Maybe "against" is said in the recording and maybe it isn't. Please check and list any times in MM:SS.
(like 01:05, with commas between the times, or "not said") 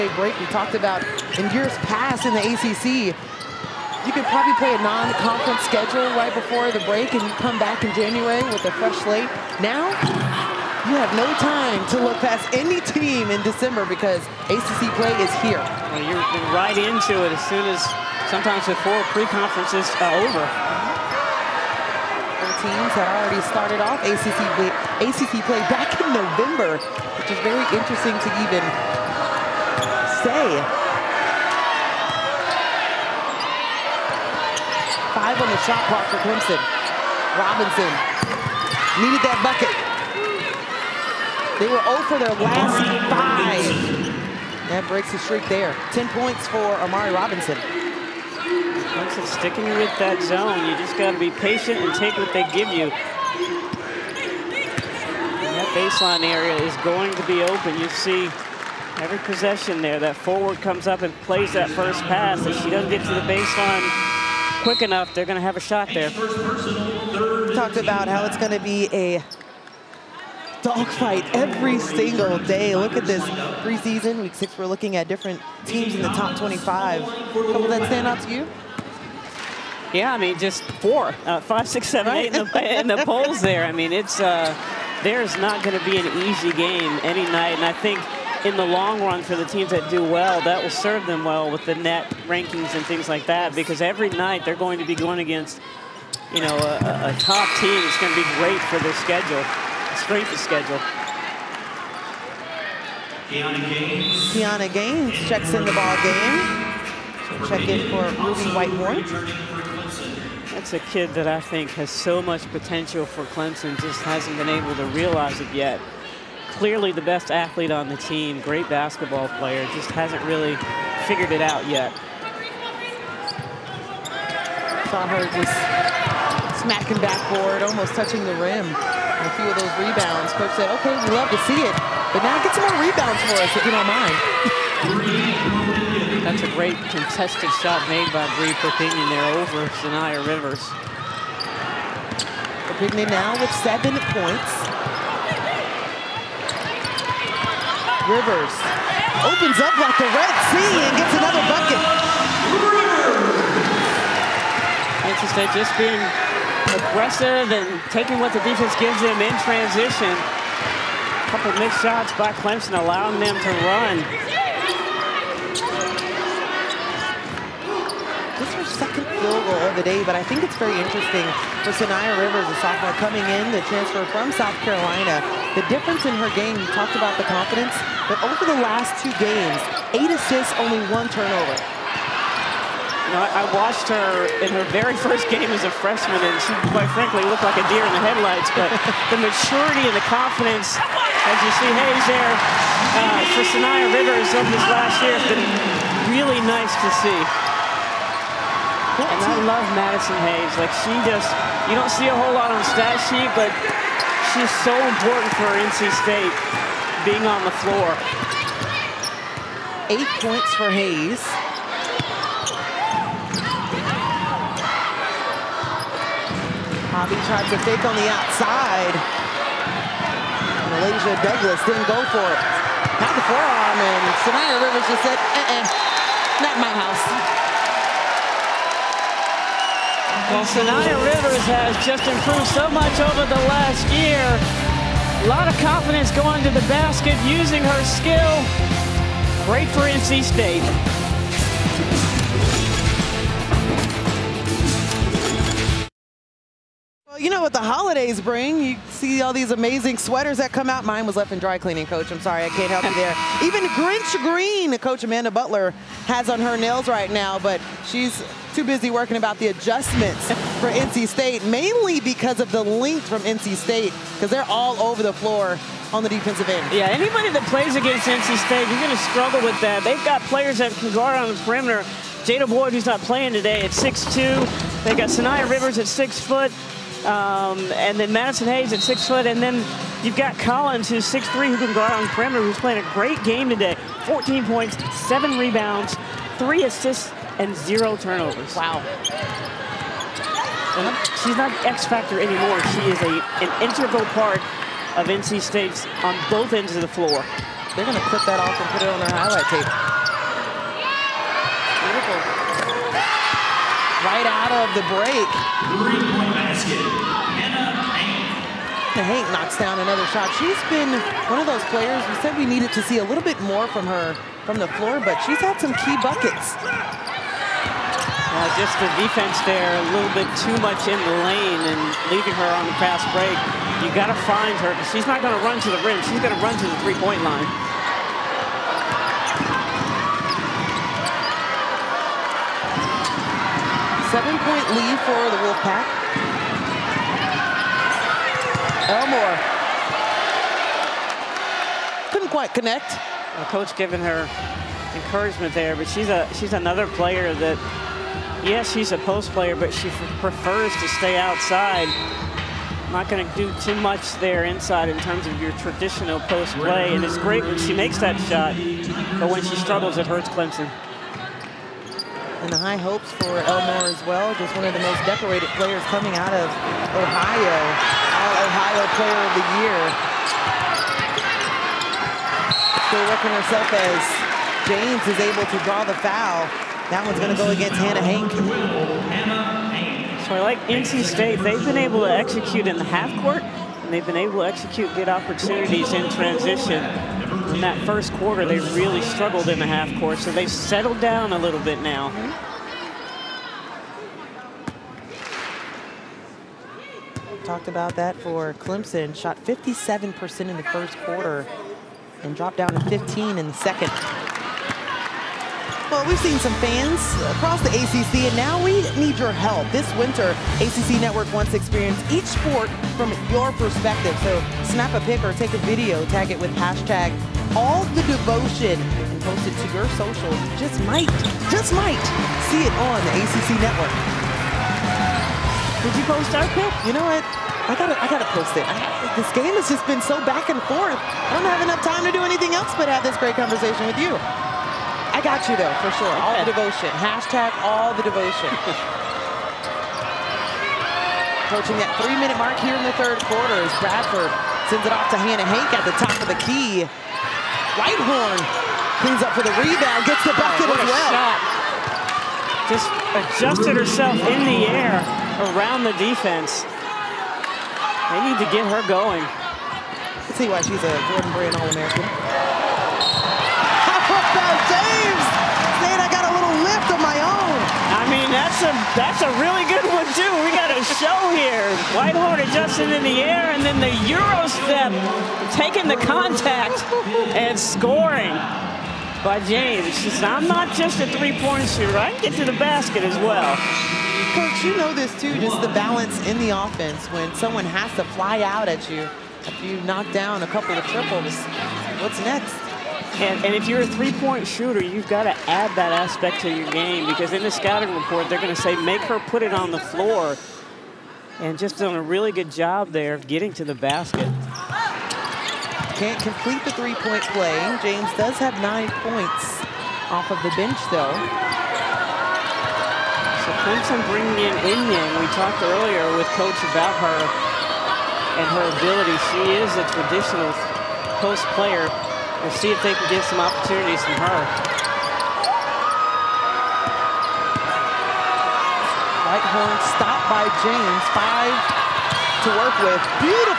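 01:35, 04:27, 06:17.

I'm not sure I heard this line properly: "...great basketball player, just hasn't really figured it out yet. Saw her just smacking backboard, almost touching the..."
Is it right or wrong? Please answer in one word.
right.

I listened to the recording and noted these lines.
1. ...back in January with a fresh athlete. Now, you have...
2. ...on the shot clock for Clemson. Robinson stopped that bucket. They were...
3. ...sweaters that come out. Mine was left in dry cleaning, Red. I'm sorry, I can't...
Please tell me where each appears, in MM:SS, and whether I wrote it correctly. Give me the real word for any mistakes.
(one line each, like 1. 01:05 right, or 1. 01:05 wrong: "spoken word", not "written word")
1. 00:07 wrong: "slate", not "athlete"
2. 00:35 wrong: "needed", not "stopped"
3. 04:09 wrong: "Coach", not "Red".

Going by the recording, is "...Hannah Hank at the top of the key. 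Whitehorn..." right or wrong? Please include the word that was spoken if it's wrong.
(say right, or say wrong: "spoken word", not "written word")
right.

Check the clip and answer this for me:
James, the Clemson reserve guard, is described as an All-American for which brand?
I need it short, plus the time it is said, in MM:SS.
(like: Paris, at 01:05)
Jordan Brand, at 07:41.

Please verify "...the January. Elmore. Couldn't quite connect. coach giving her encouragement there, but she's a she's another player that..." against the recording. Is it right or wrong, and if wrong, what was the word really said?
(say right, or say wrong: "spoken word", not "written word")
wrong: "Wolfpack", not "January".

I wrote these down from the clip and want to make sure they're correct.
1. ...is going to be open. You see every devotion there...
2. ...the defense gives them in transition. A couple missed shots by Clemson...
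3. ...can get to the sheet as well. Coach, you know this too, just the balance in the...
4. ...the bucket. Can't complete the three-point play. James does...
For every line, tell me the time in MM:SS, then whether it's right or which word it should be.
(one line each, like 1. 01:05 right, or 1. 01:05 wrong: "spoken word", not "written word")
1. 00:56 wrong: "possession", not "devotion"
2. 02:38 right
3. 08:02 wrong: "basket", not "sheet"
4. 08:23 wrong: "basket", not "bucket".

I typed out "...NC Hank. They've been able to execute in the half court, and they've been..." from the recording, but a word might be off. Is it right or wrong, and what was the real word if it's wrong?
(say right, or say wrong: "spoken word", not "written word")
wrong: "State", not "Hank".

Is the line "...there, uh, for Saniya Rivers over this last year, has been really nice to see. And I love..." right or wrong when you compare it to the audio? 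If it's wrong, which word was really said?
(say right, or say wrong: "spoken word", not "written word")
right.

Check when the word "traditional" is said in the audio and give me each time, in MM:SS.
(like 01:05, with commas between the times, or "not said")
05:55, 08:39.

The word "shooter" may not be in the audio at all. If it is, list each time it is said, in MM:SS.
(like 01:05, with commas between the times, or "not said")
08:01, 08:14.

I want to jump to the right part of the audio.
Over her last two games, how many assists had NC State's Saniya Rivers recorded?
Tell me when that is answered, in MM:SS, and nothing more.
02:59.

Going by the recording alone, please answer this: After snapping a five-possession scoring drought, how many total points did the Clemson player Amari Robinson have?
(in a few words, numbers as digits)
10.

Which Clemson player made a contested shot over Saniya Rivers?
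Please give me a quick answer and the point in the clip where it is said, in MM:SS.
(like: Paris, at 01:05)
Bree Perpignan, at 02:18.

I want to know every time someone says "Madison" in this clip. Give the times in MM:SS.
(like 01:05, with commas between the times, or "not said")
03:19, 04:38.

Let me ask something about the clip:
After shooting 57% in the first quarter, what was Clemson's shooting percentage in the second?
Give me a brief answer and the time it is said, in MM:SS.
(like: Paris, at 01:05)
15%, at 06:42.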